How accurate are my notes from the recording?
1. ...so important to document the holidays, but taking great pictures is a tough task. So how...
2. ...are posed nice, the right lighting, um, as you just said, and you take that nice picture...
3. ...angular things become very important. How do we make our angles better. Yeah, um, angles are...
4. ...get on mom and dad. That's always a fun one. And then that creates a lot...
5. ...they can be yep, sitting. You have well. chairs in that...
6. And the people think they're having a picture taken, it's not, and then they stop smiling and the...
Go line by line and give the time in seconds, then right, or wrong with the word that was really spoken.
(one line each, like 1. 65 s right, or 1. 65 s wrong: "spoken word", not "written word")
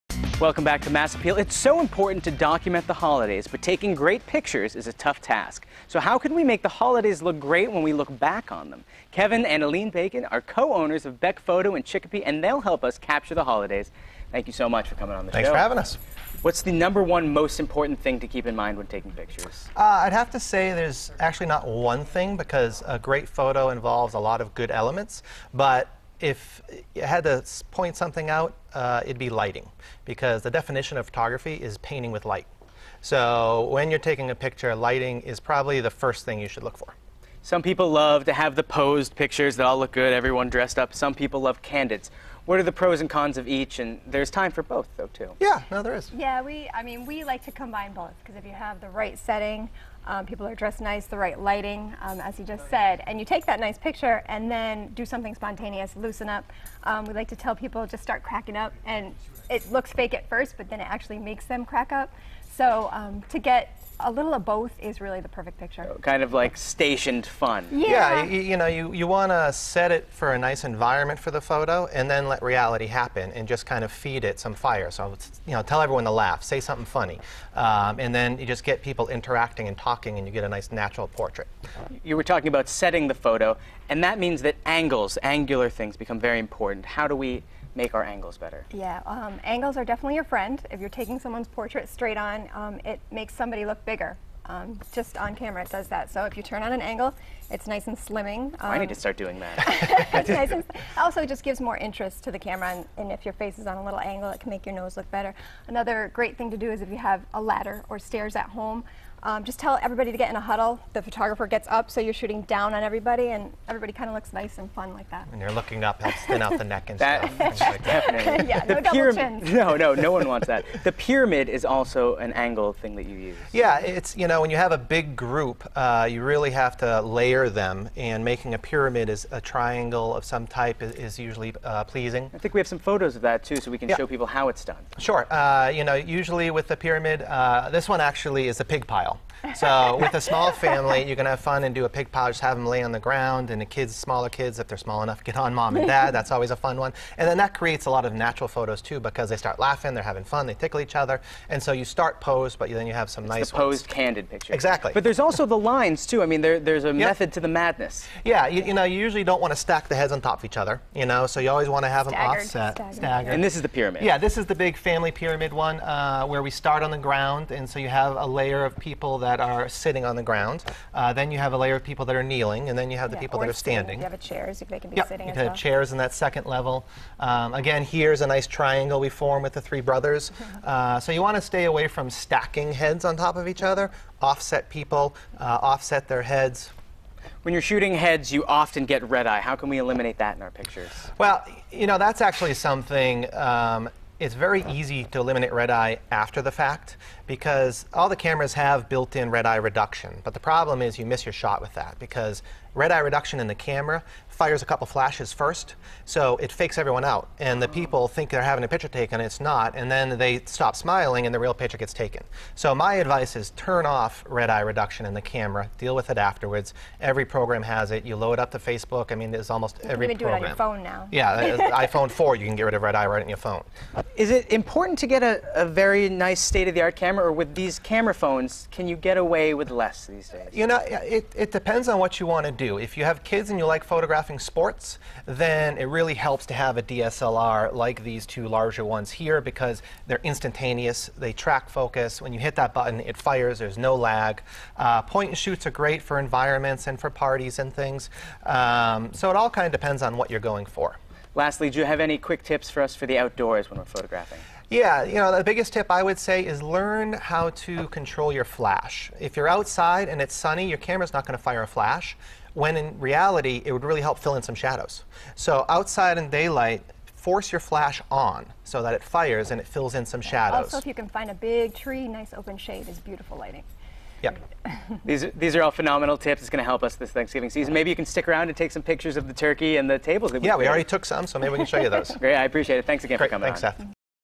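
1. 1 s right
2. 50 s wrong: "dressed", not "posed"
3. 85 s right
4. 145 s right
5. 174 s right
6. 207 s right.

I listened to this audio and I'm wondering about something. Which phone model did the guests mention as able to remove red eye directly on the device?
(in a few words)
iPhone 4.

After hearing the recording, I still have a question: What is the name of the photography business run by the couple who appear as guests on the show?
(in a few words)
Beck Photo.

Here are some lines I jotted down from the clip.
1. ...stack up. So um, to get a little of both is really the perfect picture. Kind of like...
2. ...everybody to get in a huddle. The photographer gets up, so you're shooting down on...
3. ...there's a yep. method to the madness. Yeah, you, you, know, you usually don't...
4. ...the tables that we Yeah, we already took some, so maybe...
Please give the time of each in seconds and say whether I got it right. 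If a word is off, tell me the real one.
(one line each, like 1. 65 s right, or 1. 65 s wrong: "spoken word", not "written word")
1. 61 s wrong: "crack", not "stack"
2. 109 s right
3. 156 s right
4. 279 s right.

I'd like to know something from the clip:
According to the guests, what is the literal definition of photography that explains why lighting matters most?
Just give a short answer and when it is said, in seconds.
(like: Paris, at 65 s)
Painting with light, at 31 s.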